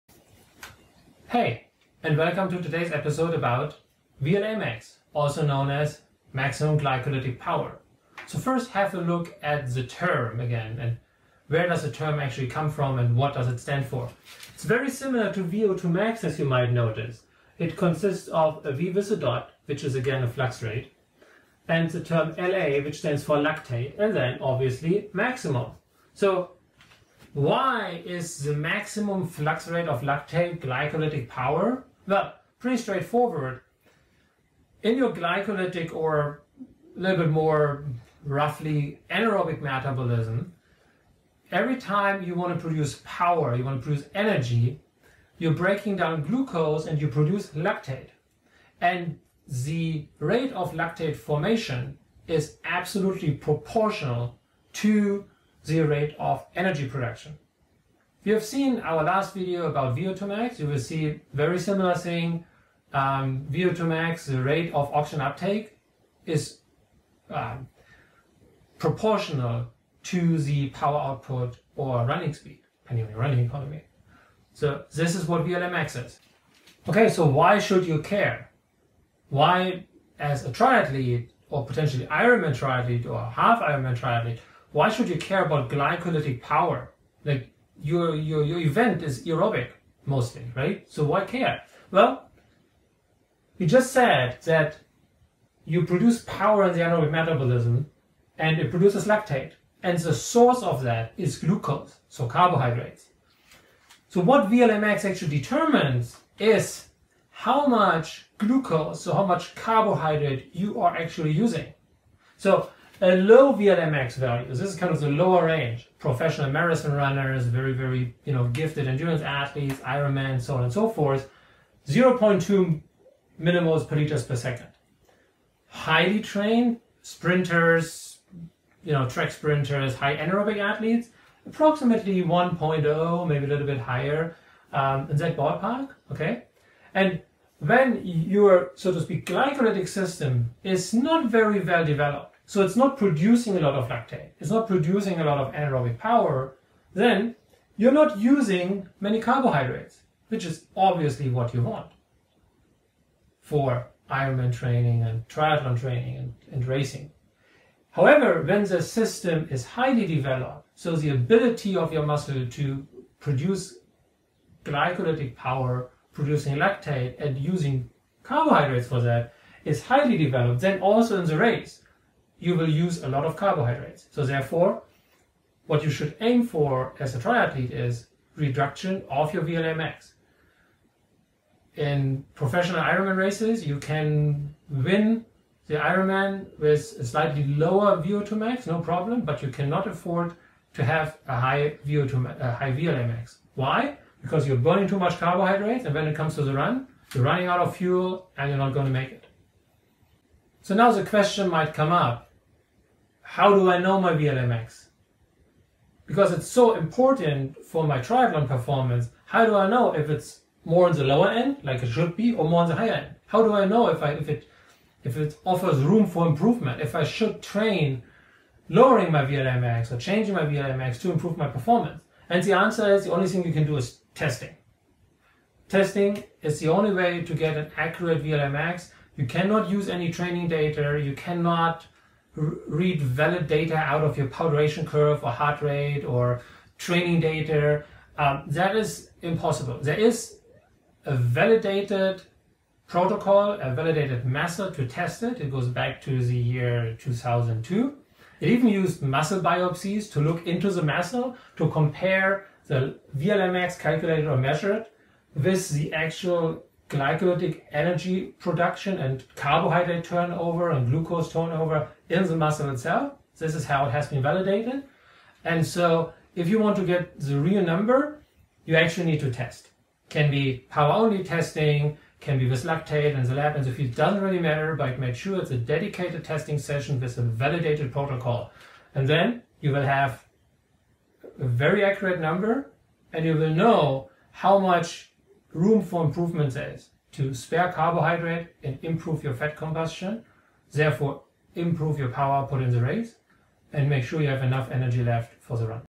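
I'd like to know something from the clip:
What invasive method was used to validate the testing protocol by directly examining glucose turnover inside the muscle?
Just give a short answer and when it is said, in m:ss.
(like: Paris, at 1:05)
Muscle biopsies, at 4:09.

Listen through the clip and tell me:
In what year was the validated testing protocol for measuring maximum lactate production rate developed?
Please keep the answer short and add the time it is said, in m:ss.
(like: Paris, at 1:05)
2002, at 4:06.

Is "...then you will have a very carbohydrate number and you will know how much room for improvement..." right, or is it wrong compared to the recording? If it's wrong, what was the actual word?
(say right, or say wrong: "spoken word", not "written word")
wrong: "accurate", not "carbohydrate".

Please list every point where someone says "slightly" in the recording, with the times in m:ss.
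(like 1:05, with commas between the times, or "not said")
3:07.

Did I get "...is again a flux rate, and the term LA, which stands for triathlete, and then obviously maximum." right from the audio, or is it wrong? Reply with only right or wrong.
wrong.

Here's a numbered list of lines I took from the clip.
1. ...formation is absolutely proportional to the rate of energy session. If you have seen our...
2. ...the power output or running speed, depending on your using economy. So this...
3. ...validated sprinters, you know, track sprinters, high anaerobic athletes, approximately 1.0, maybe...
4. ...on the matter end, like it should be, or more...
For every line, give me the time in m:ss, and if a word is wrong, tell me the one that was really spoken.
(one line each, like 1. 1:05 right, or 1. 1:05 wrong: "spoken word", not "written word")
1. 0:51 wrong: "production", not "session"
2. 1:10 wrong: "running", not "using"
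3. 2:06 wrong: "trained", not "validated"
4. 3:30 wrong: "lower", not "matter".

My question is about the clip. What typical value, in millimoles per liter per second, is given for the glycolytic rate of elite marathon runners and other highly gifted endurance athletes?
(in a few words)
0.2.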